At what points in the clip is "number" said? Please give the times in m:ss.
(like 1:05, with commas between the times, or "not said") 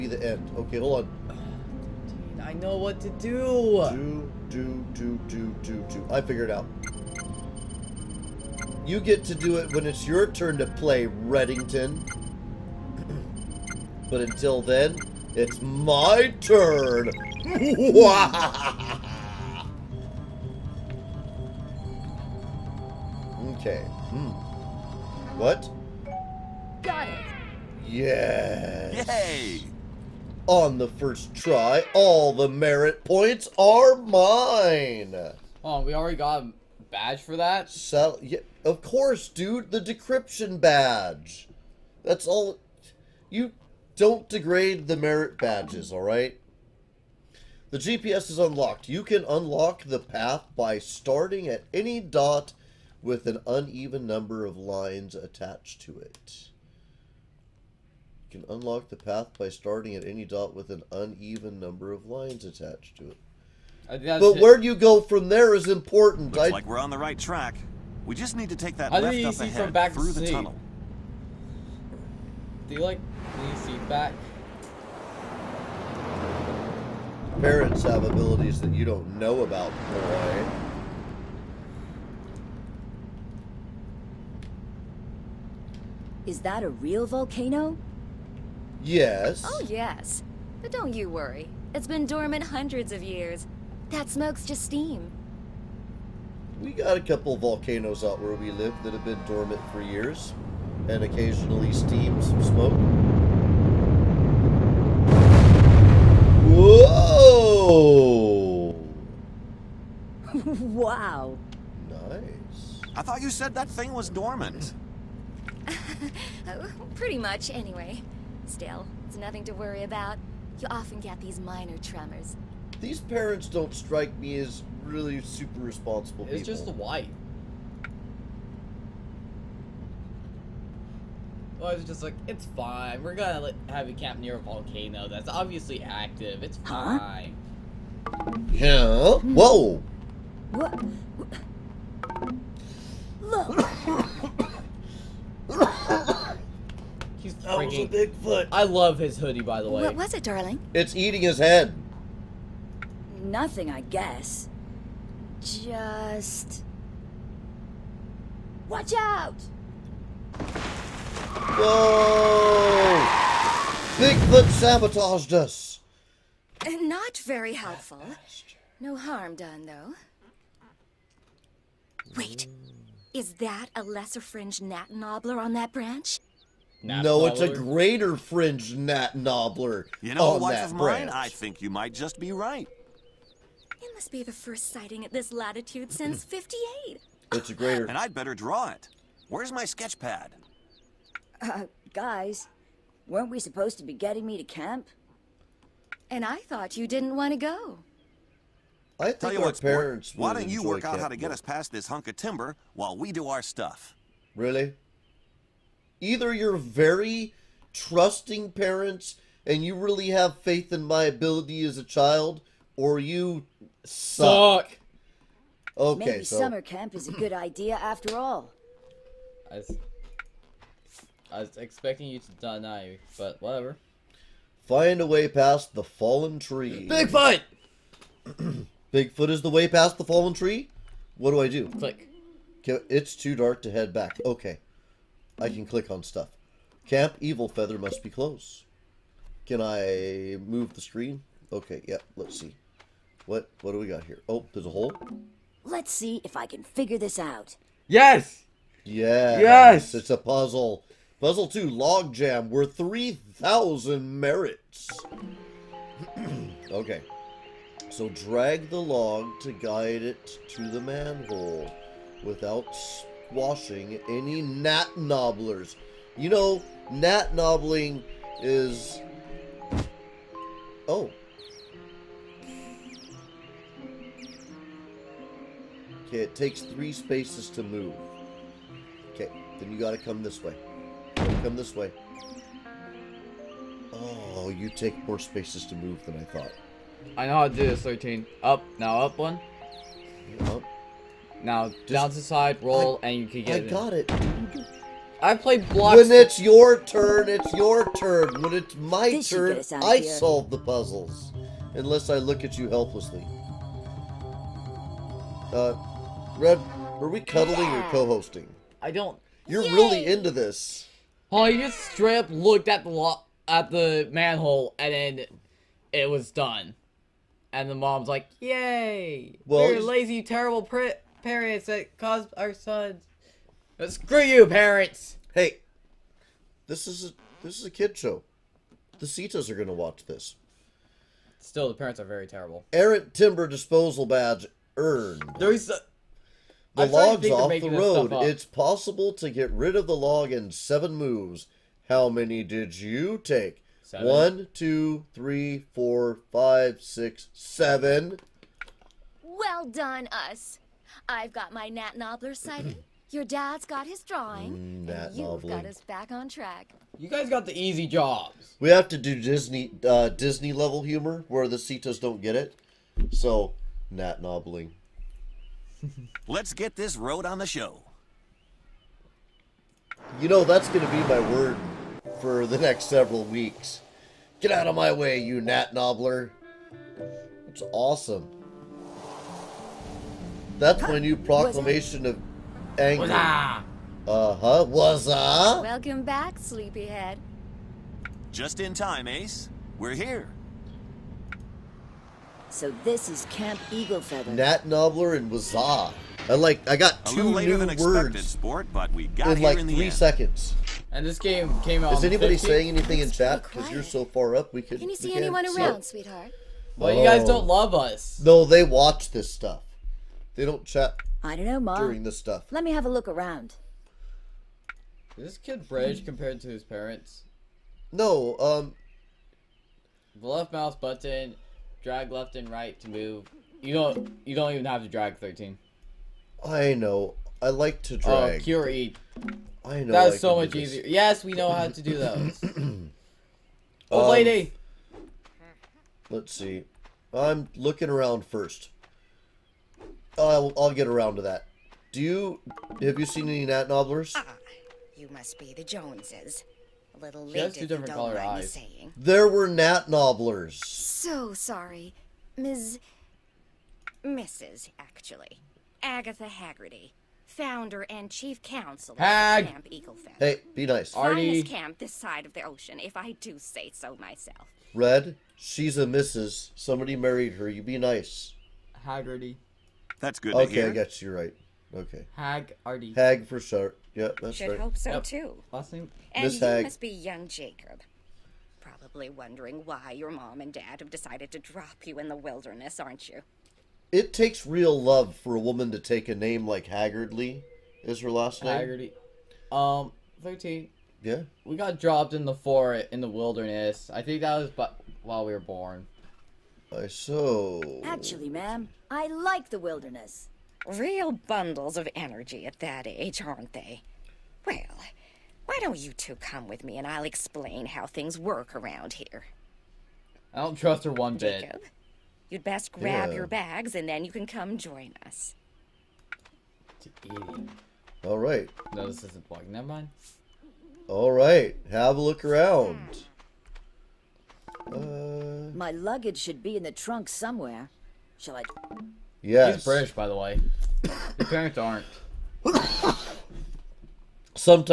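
0:54, 1:01.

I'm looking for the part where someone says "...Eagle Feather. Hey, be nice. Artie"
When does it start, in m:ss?
7:39.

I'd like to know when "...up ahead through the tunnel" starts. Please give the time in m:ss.
1:09.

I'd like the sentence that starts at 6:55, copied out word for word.
Is this kid British compared to his parents?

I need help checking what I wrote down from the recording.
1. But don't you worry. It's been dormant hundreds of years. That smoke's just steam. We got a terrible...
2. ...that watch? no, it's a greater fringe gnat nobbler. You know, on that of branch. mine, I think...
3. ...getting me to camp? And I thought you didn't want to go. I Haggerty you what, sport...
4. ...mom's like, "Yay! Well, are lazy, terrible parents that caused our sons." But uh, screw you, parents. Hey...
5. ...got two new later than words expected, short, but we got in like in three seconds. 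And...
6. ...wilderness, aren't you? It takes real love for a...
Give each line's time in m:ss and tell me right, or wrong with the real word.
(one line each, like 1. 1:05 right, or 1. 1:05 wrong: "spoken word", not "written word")
1. 1:30 wrong: "couple", not "terrible"
2. 2:55 wrong: "branch", not "watch"
3. 3:13 wrong: "Tell", not "Haggerty"
4. 5:17 right
5. 6:36 wrong: "sport", not "short"
6. 8:02 right.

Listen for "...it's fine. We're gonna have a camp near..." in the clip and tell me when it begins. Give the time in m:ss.
2:12.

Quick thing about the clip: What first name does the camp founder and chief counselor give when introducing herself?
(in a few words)
Agatha.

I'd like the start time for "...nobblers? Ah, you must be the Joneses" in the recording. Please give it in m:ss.
7:23.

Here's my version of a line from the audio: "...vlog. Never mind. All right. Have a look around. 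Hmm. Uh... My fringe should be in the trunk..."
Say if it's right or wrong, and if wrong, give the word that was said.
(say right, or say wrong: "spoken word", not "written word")
wrong: "luggage", not "fringe".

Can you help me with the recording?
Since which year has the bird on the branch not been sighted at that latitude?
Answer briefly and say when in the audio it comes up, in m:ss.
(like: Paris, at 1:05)
58, at 3:06.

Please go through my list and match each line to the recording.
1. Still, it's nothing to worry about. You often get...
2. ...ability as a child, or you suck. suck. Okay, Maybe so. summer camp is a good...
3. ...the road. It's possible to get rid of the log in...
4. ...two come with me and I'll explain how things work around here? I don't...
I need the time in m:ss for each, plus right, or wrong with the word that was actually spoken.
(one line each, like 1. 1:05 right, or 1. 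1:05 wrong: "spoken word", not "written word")
1. 1:58 right
2. 3:31 right
3. 5:37 right
4. 8:25 right.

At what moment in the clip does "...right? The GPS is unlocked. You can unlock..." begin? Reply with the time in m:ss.
0:46.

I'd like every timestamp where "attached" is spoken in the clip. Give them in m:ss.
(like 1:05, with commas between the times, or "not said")
0:55, 1:02.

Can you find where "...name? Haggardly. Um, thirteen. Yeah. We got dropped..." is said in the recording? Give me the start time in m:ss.
8:08.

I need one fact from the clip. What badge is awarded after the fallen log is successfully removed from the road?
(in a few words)
Errant timber disposal.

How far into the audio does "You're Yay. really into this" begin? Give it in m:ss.
5:09.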